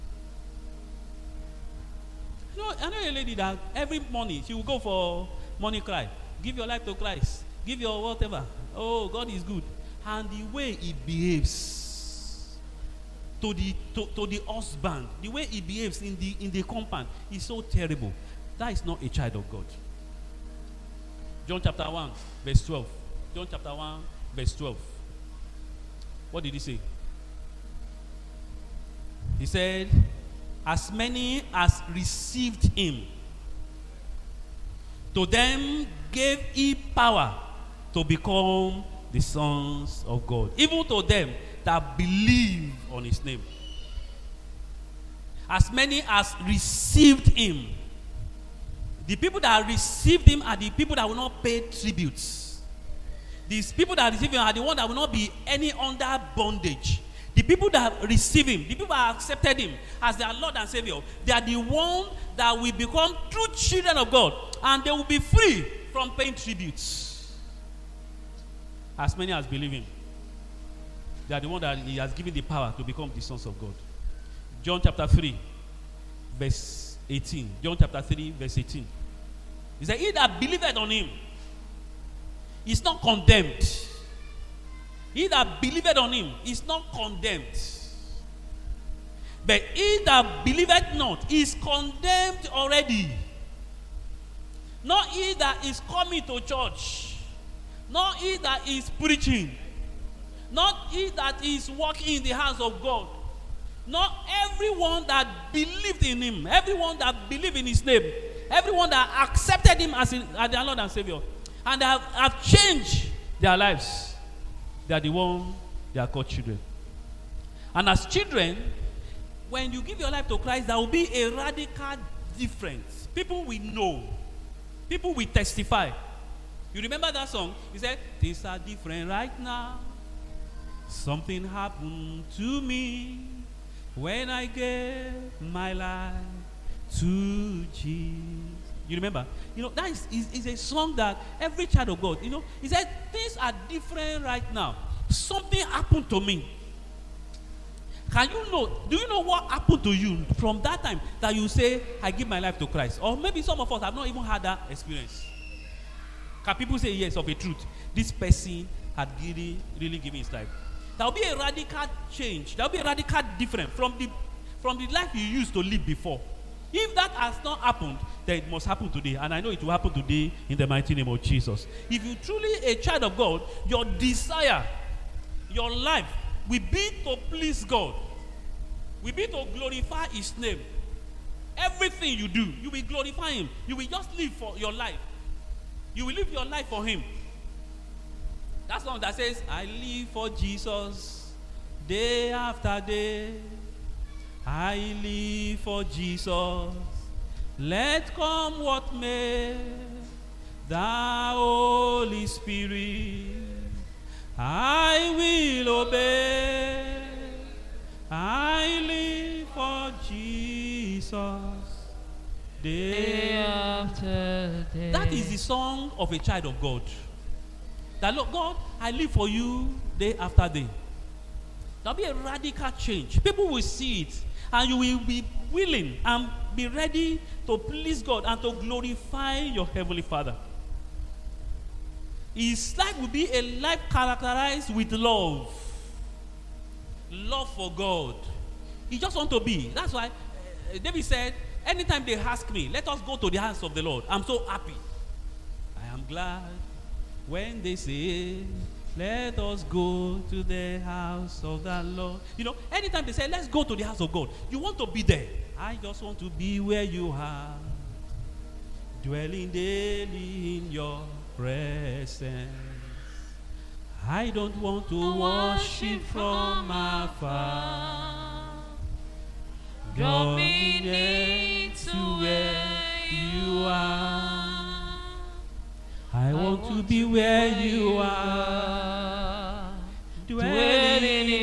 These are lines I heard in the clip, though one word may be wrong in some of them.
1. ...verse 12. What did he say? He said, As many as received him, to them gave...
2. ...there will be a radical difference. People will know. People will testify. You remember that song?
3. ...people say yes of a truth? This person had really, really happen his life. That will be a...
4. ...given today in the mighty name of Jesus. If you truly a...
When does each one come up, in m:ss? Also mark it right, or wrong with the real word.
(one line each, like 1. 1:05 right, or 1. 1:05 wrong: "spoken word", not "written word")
1. 0:24 right
2. 2:00 right
3. 2:36 wrong: "given", not "happen"
4. 2:49 wrong: "happen", not "given".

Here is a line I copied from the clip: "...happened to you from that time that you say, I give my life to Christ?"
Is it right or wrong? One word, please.
right.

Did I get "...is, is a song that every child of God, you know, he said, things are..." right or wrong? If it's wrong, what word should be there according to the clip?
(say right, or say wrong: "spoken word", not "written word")
right.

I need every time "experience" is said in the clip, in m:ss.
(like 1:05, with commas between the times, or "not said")
2:34.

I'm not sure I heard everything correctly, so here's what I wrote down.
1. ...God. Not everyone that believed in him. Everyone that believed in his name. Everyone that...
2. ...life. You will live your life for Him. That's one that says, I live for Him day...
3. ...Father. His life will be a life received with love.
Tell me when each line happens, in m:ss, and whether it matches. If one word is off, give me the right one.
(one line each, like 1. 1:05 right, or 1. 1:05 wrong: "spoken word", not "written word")
1. 1:42 right
2. 3:04 wrong: "Jesus", not "Him"
3. 3:50 wrong: "characterized", not "received".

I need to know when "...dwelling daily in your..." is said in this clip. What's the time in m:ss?
4:19.